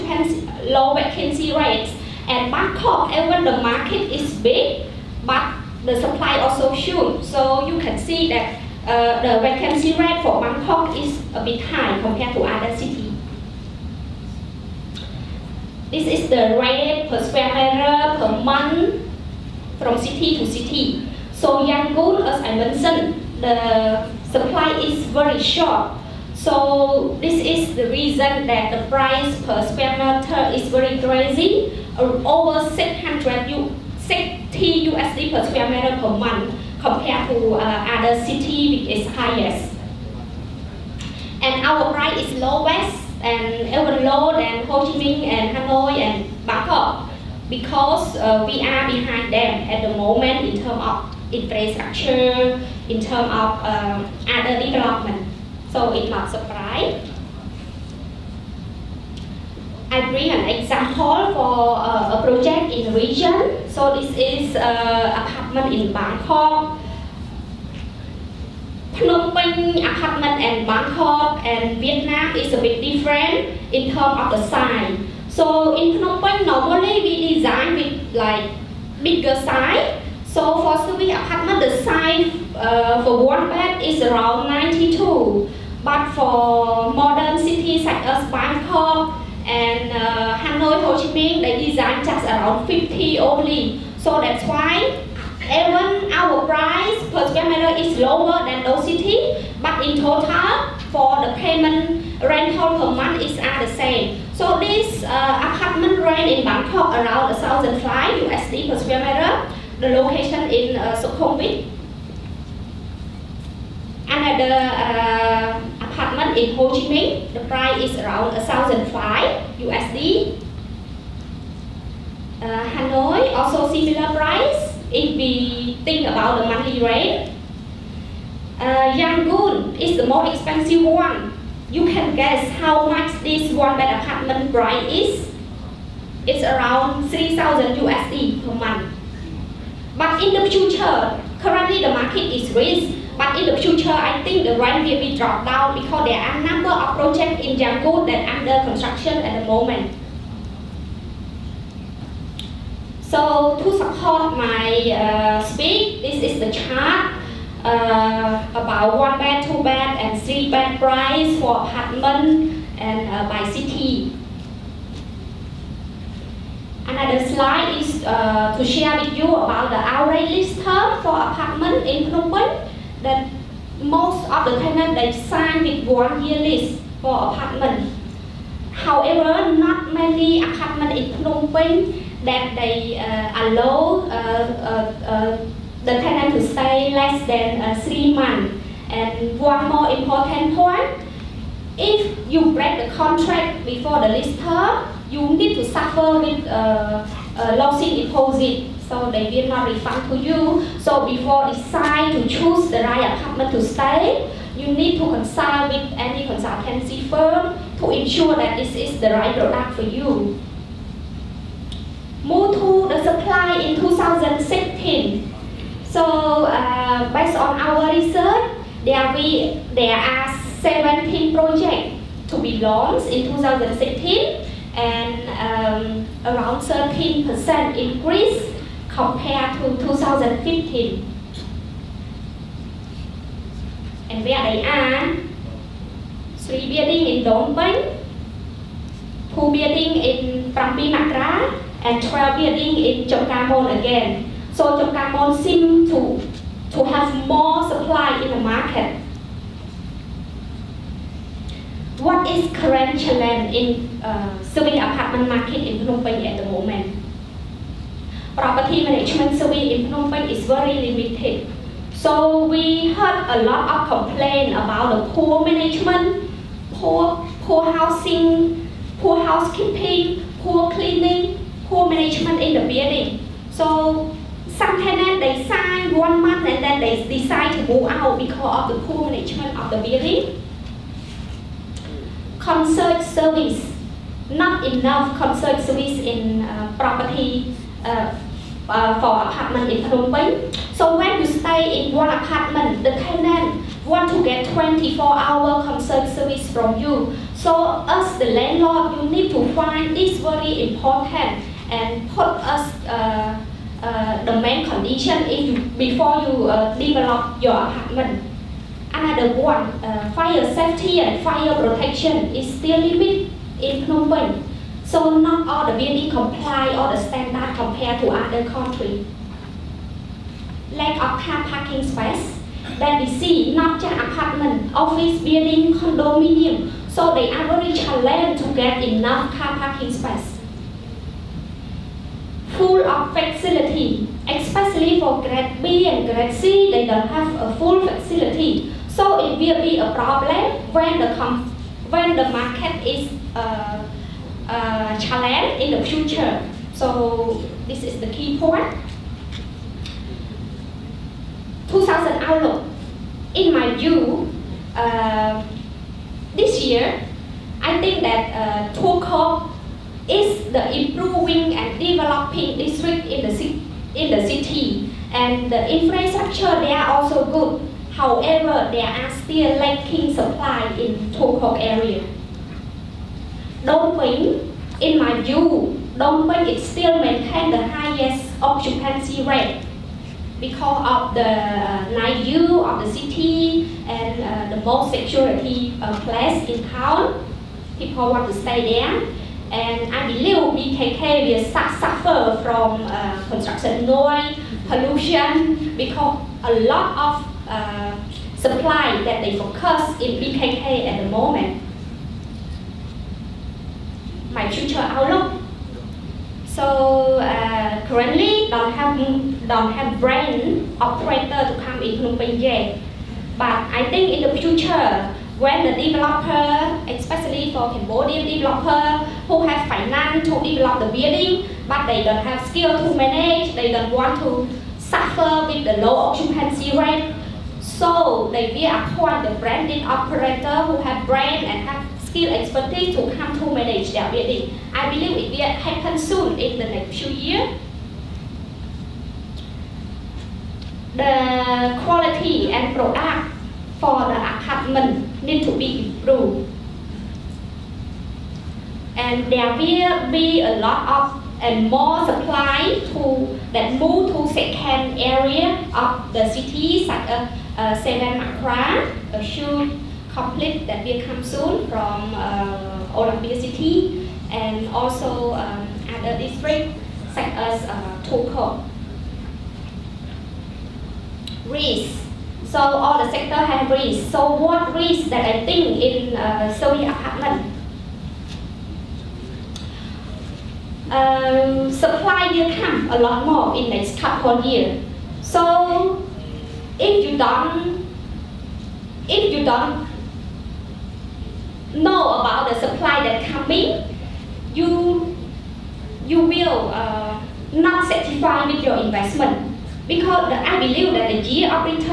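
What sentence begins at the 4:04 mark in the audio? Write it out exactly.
So Chamkarmon seems to, to have more supply in the market.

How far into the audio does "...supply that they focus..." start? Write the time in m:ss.
6:38.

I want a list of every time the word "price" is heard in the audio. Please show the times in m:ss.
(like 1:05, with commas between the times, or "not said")
0:28, 0:41, 1:36, 1:57, 2:04, 2:14, 2:40.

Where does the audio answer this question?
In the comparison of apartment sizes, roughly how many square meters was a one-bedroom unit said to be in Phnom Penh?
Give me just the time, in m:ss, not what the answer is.
1:24.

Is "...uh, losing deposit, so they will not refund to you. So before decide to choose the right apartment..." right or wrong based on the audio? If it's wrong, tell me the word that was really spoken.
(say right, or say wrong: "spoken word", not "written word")
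right.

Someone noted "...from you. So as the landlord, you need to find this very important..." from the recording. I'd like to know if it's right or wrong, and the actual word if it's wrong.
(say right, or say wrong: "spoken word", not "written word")
right.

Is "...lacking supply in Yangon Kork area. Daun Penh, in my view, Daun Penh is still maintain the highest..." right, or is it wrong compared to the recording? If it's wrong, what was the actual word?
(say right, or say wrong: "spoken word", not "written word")
wrong: "Tuol", not "Yangon".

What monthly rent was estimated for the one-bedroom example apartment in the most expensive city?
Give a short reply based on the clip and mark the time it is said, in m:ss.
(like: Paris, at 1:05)
3,000 USD, at 2:17.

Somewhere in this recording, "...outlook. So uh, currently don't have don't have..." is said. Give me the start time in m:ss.
6:44.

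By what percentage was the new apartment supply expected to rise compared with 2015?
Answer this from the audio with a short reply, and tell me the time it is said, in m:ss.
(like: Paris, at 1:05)
13%, at 3:46.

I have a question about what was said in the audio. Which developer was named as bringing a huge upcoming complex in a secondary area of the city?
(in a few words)
Olympia City.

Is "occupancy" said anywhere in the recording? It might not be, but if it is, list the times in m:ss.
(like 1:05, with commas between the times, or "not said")
6:18, 7:05.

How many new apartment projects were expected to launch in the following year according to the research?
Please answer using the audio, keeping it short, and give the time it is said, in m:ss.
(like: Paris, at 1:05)
17, at 3:40.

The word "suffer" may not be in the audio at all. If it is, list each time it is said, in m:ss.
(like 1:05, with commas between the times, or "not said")
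3:15, 6:31, 7:04.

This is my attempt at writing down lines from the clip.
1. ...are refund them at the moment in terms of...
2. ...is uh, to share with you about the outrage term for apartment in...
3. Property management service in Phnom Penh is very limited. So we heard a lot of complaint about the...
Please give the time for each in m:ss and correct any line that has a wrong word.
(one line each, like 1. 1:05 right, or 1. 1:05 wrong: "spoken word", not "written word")
1. 0:48 wrong: "behind", not "refund"
2. 2:47 right
3. 4:18 right.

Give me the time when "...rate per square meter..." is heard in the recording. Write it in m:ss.
0:16.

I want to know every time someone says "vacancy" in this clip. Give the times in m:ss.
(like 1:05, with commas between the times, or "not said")
0:00, 0:09.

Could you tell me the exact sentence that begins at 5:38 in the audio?
So it will be a problem when the, when the market is uh, uh, challenged in the future.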